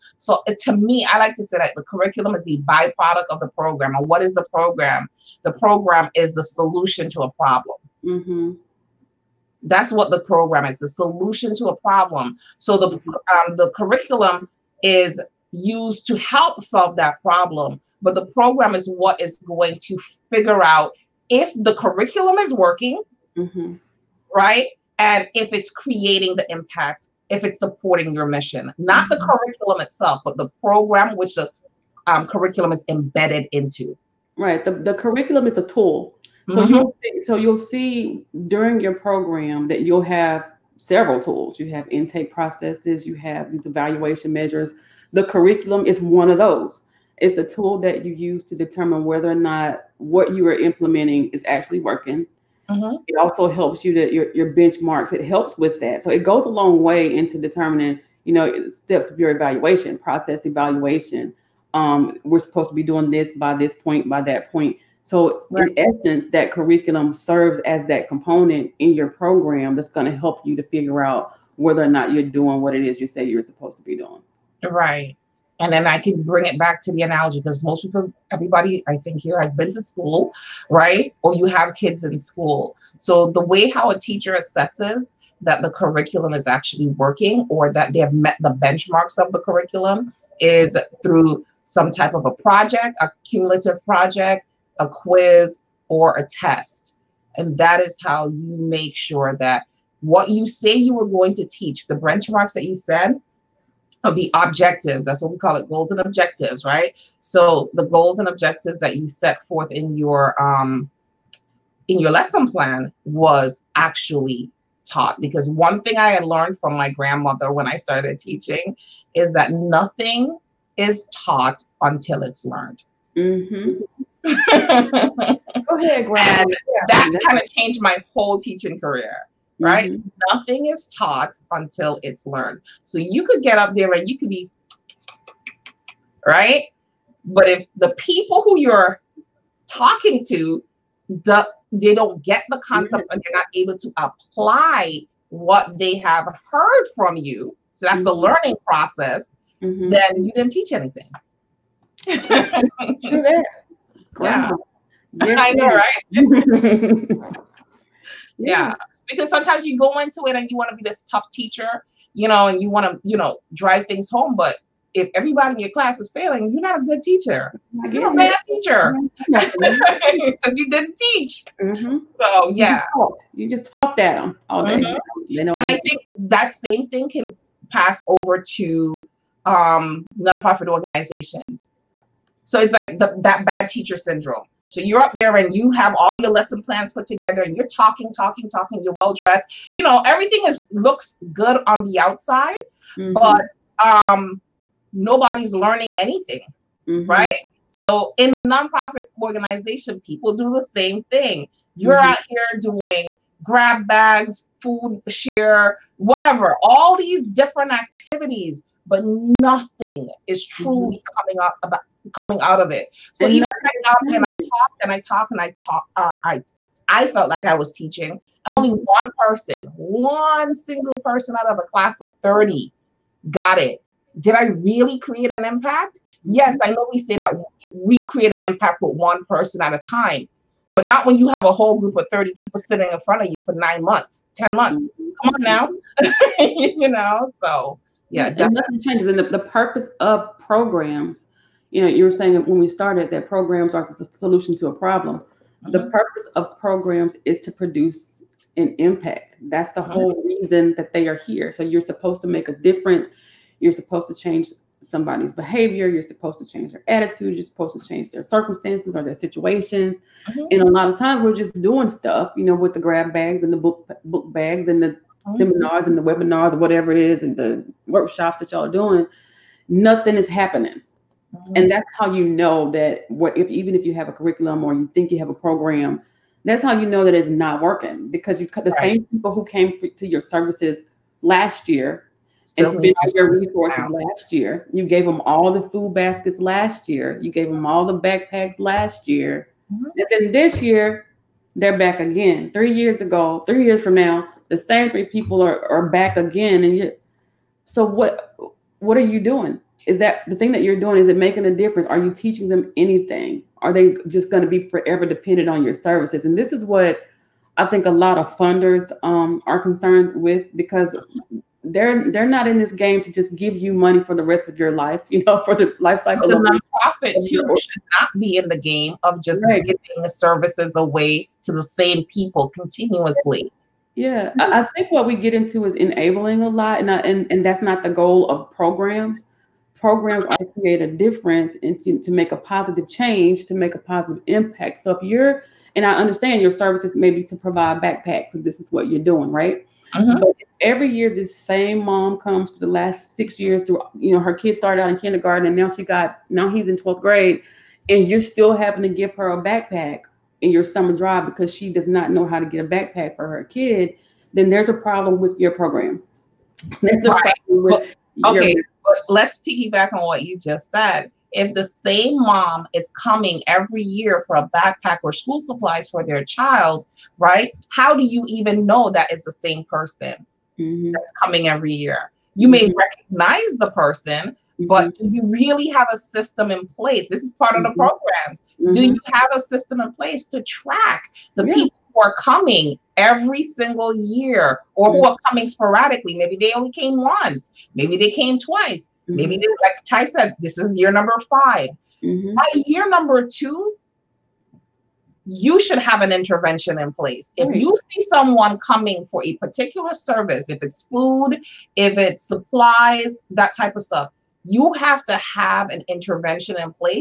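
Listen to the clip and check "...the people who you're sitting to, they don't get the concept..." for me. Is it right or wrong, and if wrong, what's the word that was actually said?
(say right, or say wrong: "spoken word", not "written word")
wrong: "talking", not "sitting".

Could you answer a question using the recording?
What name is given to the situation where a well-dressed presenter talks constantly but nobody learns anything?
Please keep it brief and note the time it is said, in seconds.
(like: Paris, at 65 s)
Bad teacher syndrome, at 183 s.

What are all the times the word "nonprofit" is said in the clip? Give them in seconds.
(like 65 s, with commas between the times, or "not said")
180 s, 198 s, 316 s.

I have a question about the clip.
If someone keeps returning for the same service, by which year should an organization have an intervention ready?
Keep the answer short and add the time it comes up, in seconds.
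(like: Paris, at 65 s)
Year 2, at 392 s.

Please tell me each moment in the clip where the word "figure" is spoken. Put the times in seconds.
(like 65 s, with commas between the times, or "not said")
20 s, 70 s.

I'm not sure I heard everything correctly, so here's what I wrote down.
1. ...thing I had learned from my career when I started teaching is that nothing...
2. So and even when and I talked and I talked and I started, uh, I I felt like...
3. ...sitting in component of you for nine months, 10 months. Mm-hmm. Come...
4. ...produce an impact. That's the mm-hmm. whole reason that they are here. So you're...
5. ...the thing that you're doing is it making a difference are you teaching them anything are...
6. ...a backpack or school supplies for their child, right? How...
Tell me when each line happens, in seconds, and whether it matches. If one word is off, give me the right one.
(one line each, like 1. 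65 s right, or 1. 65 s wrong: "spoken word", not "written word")
1. 115 s wrong: "grandmother", not "career"
2. 213 s wrong: "talked", not "started"
3. 232 s wrong: "front", not "component"
4. 247 s right
5. 300 s right
6. 364 s right.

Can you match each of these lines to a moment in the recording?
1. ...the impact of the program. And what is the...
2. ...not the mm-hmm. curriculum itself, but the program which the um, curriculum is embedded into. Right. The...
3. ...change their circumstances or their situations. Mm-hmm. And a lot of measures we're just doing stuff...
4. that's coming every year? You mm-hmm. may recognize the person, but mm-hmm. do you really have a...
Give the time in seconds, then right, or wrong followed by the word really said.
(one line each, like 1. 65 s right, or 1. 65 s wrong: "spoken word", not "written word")
1. 2 s wrong: "byproduct", not "impact"
2. 28 s right
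3. 257 s wrong: "times", not "measures"
4. 370 s right.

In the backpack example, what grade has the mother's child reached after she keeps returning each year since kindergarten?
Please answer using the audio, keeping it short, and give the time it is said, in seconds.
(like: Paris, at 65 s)
Twelfth grade, at 346 s.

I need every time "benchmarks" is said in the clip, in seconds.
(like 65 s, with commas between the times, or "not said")
54 s, 88 s, 101 s.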